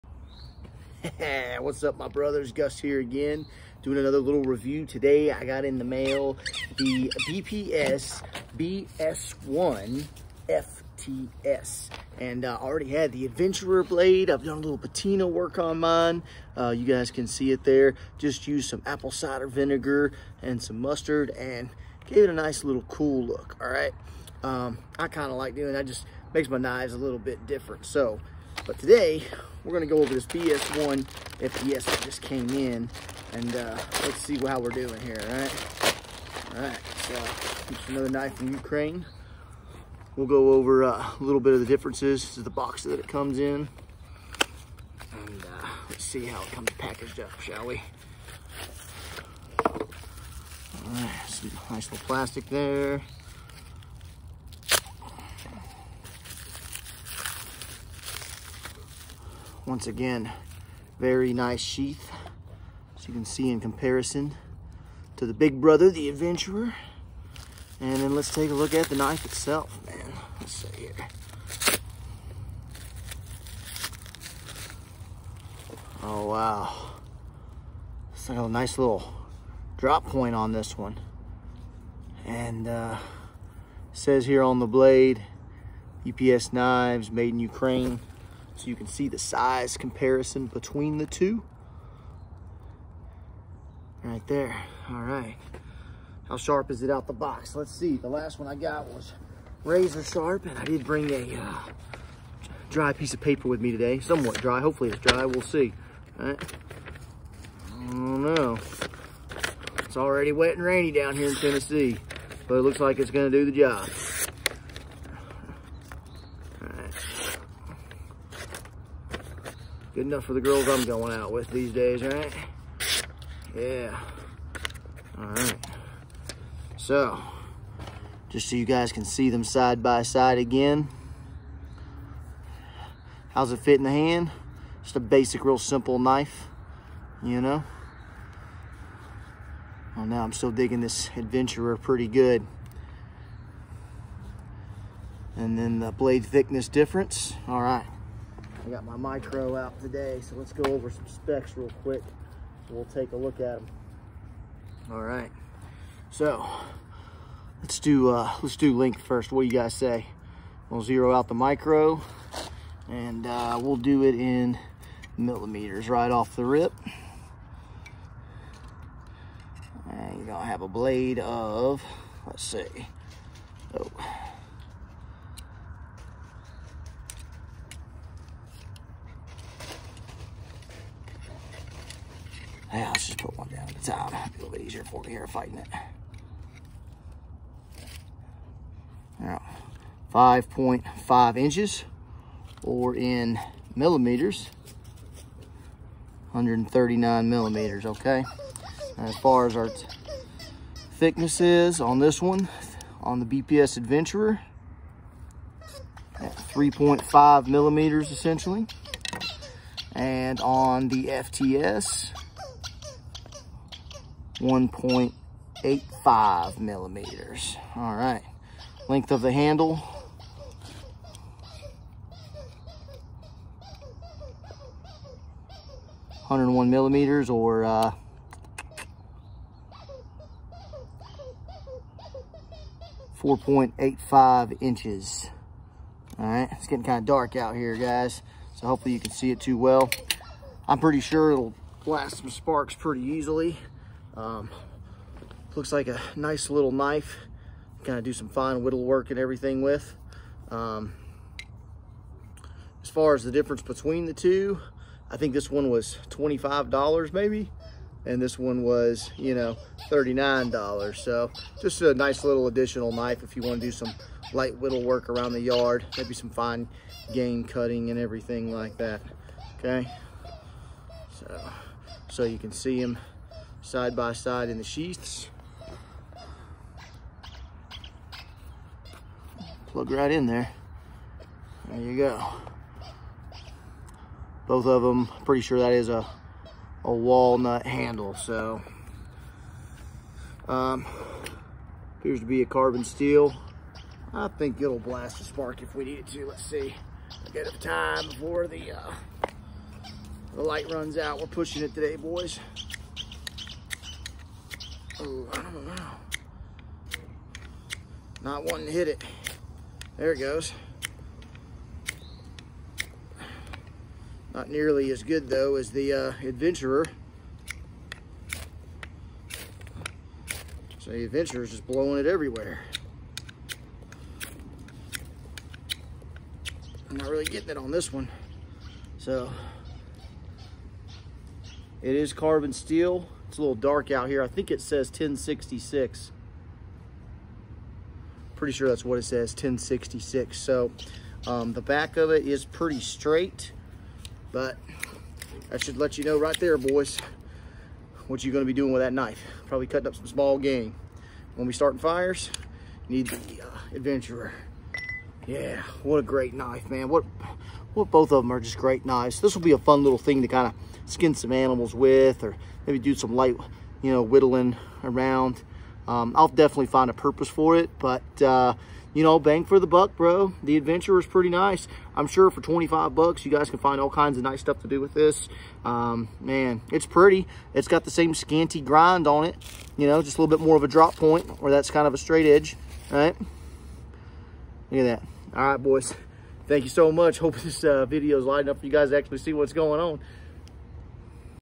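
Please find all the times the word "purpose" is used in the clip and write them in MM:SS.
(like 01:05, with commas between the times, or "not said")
06:06.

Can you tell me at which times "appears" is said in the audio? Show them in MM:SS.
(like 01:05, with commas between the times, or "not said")
04:51.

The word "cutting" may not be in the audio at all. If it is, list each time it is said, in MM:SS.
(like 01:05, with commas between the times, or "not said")
04:27, 05:49.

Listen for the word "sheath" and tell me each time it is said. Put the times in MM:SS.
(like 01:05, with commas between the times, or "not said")
01:01, 04:34.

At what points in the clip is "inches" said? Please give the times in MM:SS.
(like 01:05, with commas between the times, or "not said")
03:11, 03:54.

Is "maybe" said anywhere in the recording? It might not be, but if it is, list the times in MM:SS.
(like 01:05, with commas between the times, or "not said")
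04:17, 04:25, 06:02.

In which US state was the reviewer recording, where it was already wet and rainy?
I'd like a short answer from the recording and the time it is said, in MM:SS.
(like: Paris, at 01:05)
Tennessee, at 01:51.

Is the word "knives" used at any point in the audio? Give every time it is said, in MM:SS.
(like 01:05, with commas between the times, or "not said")
00:26, 01:26, 05:58.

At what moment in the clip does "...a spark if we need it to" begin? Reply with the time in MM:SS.
04:55.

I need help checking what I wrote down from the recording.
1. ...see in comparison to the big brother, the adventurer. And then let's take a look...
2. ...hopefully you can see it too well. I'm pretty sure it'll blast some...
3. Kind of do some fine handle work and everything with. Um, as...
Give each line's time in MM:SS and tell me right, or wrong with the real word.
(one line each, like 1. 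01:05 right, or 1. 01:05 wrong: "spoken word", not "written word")
1. 01:03 right
2. 03:58 right
3. 04:07 wrong: "whittle", not "handle".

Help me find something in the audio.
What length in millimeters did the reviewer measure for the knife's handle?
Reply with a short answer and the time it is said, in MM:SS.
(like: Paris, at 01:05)
101 millimeters, at 03:46.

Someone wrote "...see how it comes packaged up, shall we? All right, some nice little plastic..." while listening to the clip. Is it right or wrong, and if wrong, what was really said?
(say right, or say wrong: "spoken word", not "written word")
right.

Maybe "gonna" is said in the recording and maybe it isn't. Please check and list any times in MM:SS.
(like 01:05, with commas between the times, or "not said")
00:29, 01:53, 02:50, 05:48.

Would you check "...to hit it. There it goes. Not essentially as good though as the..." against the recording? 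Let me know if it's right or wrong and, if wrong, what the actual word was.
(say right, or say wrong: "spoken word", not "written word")
wrong: "nearly", not "essentially".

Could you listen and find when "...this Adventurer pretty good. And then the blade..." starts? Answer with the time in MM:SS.
02:20.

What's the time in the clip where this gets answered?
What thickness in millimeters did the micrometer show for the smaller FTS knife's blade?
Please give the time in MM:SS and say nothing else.
03:34.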